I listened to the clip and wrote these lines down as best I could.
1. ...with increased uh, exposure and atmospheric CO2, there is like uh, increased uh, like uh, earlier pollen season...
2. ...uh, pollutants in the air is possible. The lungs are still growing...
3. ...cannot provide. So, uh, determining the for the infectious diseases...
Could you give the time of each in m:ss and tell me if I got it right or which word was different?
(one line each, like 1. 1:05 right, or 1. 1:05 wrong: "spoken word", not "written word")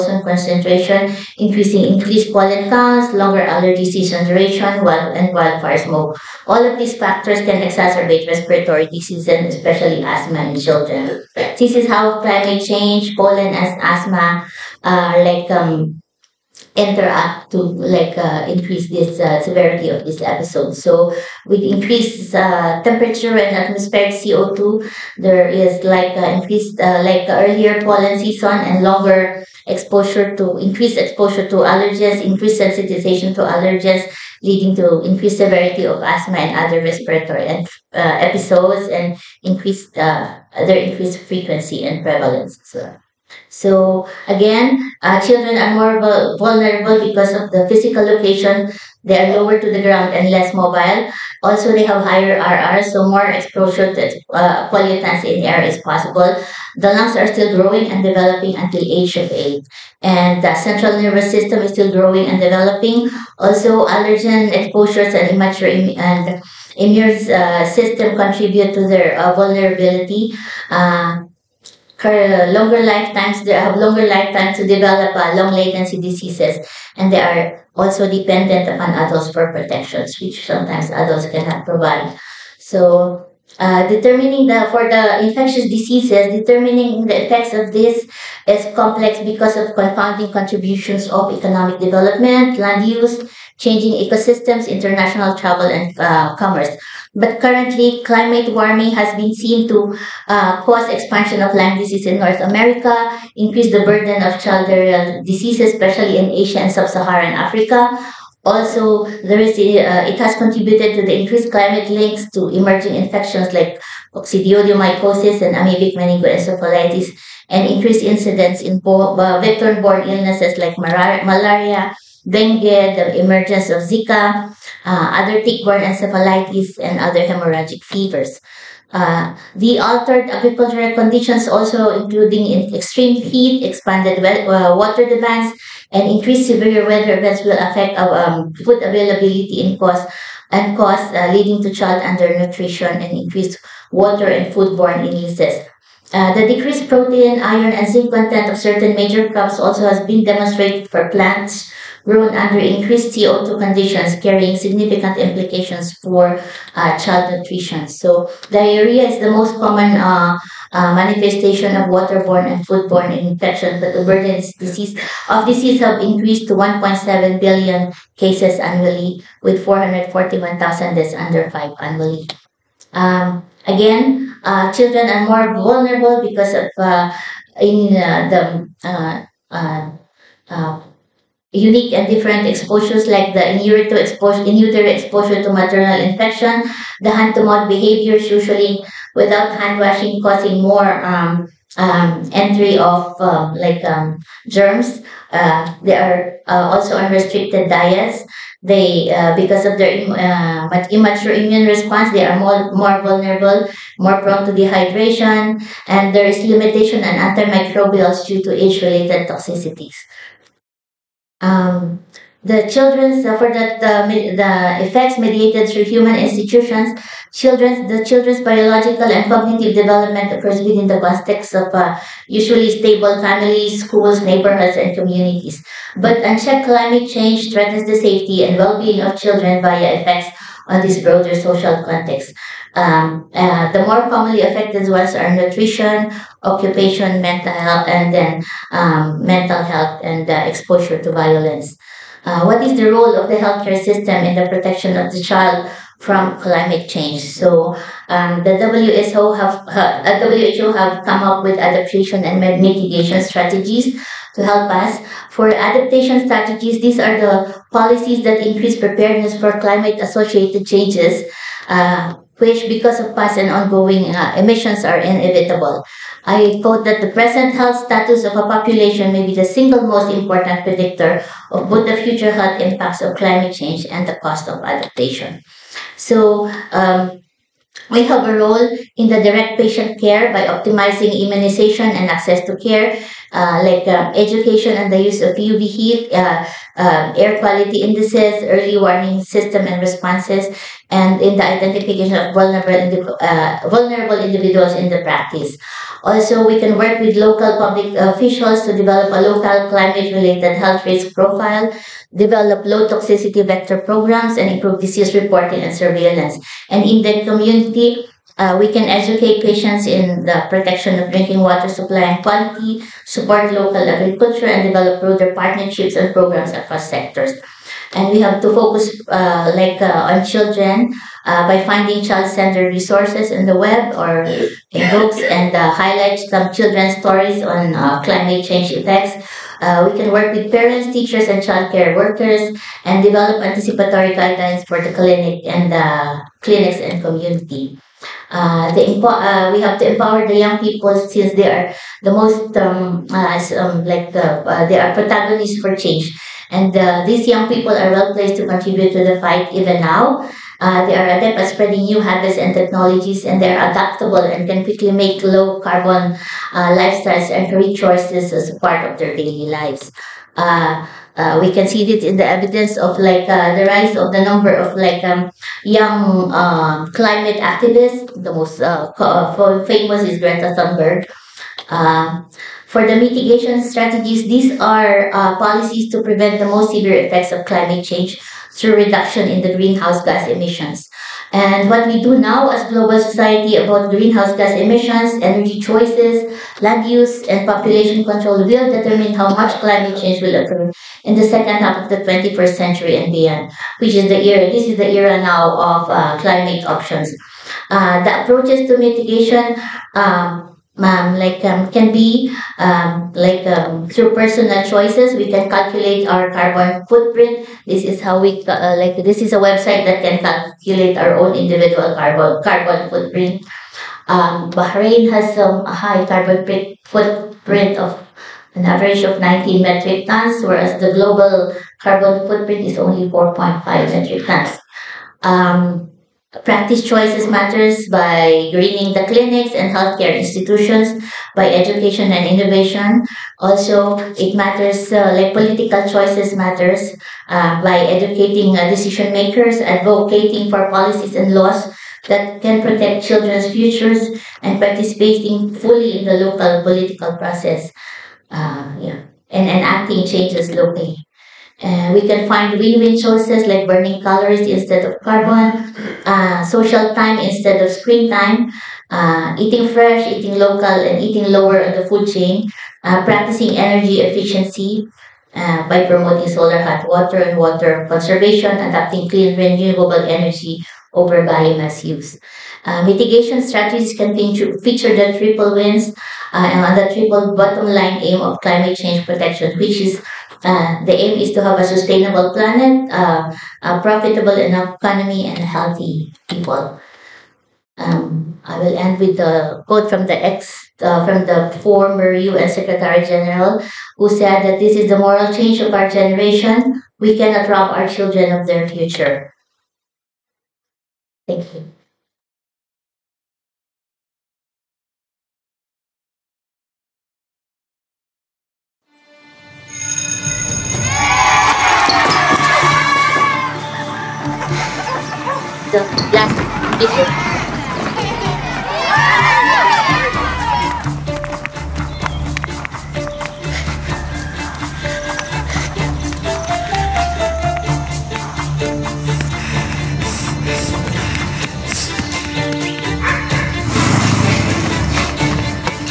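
1. 0:21 wrong: "temperature", not "exposure"
2. 0:54 right
3. 1:21 right.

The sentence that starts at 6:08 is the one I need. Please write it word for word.
The most uh, uh, famous is Greta Thunberg.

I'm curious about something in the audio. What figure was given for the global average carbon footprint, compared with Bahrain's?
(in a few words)
4.5 metric tons.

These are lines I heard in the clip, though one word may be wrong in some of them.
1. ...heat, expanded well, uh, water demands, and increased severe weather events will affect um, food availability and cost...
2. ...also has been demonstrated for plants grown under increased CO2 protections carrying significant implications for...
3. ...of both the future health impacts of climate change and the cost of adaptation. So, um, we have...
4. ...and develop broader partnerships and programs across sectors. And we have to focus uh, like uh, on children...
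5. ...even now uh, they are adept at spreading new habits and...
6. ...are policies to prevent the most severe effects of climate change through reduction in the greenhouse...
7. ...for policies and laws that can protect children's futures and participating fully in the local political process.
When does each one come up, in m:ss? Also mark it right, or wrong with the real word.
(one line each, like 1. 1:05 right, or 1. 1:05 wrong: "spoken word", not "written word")
1. 2:13 right
2. 2:29 wrong: "conditions", not "protections"
3. 4:31 right
4. 5:14 right
5. 5:49 right
6. 6:14 right
7. 7:20 right.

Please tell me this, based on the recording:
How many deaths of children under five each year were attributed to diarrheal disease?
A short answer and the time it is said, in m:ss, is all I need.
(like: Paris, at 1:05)
441,000, at 2:49.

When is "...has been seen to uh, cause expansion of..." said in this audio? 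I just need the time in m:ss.
1:38.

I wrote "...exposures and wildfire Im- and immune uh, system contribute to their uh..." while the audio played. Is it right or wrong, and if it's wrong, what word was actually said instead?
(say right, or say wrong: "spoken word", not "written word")
wrong: "immature", not "wildfire".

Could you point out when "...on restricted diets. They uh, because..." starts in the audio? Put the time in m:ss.
3:16.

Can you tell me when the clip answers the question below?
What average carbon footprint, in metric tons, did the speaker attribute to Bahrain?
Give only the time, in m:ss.
6:59.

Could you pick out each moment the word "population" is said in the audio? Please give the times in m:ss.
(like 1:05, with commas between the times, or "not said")
4:28, 6:27.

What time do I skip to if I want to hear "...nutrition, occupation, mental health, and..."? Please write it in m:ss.
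3:55.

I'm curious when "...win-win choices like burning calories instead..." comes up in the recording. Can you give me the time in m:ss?
7:32.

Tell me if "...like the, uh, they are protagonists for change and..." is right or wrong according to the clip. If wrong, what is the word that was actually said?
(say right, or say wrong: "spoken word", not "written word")
right.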